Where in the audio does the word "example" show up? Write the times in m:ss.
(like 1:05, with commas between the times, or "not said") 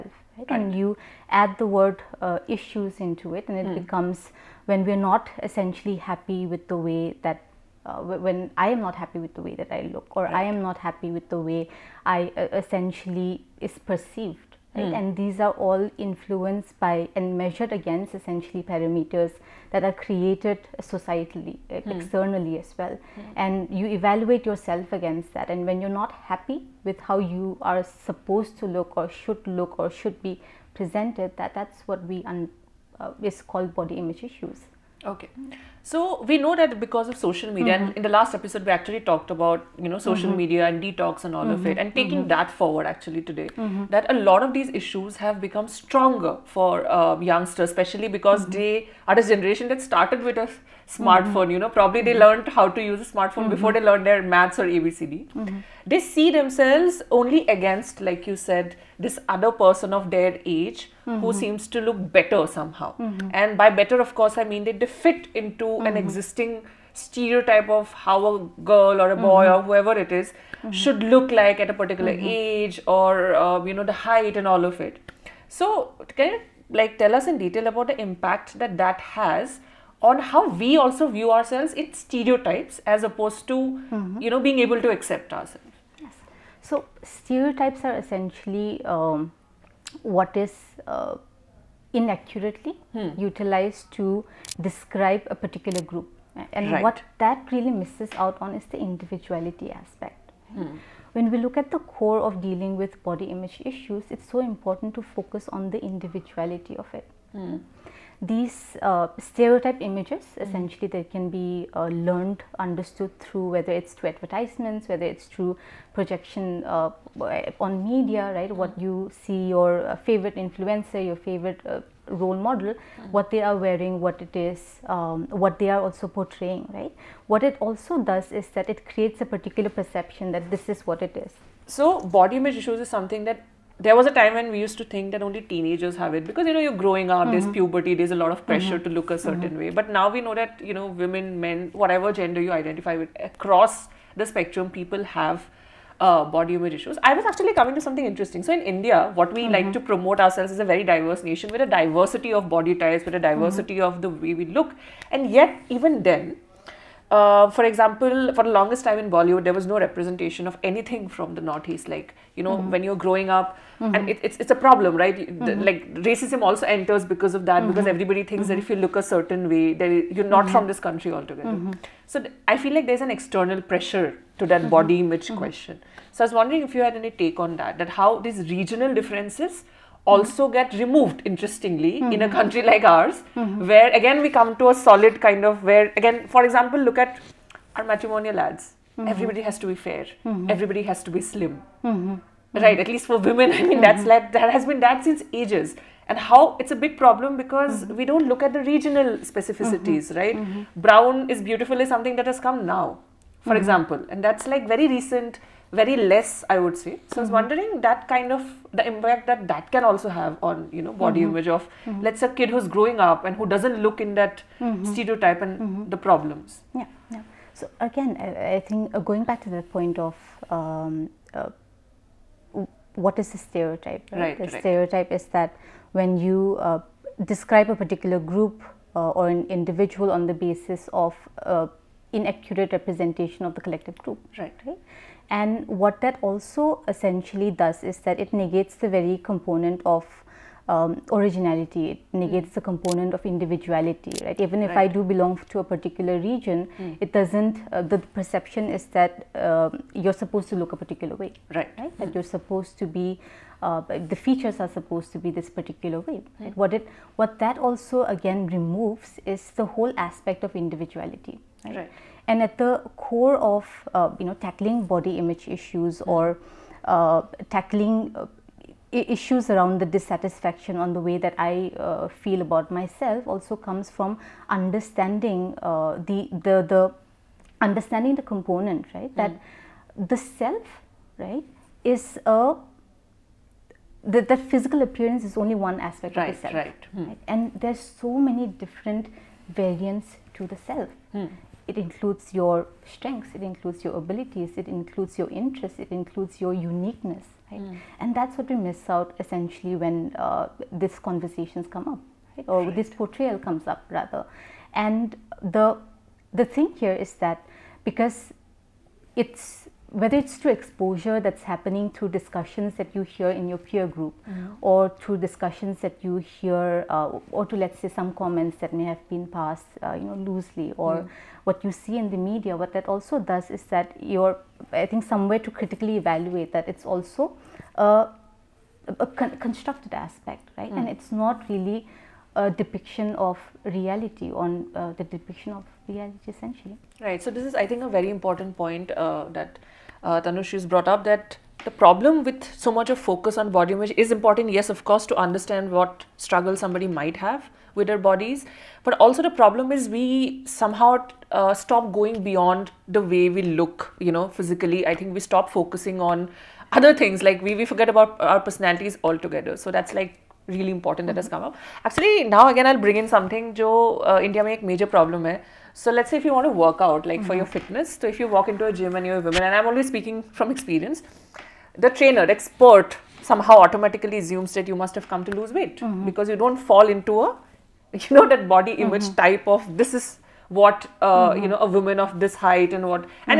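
2:37, 3:06, 3:23.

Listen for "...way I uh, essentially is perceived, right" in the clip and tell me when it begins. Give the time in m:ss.
0:11.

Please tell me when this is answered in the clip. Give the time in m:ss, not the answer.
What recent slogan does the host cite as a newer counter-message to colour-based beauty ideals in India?
3:20.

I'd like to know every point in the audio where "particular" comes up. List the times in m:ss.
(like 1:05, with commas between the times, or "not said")
1:11, 1:35, 2:09, 3:47, 4:05, 4:10, 4:15.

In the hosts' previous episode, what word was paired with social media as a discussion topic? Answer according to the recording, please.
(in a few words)
detox.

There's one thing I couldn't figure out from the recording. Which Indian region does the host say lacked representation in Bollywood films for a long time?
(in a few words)
the Northeast.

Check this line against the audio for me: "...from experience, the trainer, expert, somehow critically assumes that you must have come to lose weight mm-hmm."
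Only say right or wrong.
wrong.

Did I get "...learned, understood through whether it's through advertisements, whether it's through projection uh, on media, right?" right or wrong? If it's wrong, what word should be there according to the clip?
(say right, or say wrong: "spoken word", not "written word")
right.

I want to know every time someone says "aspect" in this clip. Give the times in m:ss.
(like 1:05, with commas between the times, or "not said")
1:39, 4:20, 4:45, 5:29.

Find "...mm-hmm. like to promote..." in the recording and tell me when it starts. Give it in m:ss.
2:29.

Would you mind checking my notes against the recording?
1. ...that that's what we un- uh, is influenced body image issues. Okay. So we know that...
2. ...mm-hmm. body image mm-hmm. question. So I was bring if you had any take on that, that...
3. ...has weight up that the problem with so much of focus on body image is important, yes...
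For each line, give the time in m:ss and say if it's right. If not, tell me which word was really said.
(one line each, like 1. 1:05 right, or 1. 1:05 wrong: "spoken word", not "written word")
1. 0:31 wrong: "called", not "influenced"
2. 2:54 wrong: "wondering", not "bring"
3. 5:40 wrong: "brought", not "weight".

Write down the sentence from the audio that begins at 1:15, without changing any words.
So can you like tell us in detail about the impact that that has?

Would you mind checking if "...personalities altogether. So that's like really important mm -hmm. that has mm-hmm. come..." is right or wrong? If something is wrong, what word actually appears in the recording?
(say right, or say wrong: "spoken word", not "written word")
right.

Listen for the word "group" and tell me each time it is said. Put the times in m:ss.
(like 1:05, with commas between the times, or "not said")
1:35, 3:48, 3:53, 5:13.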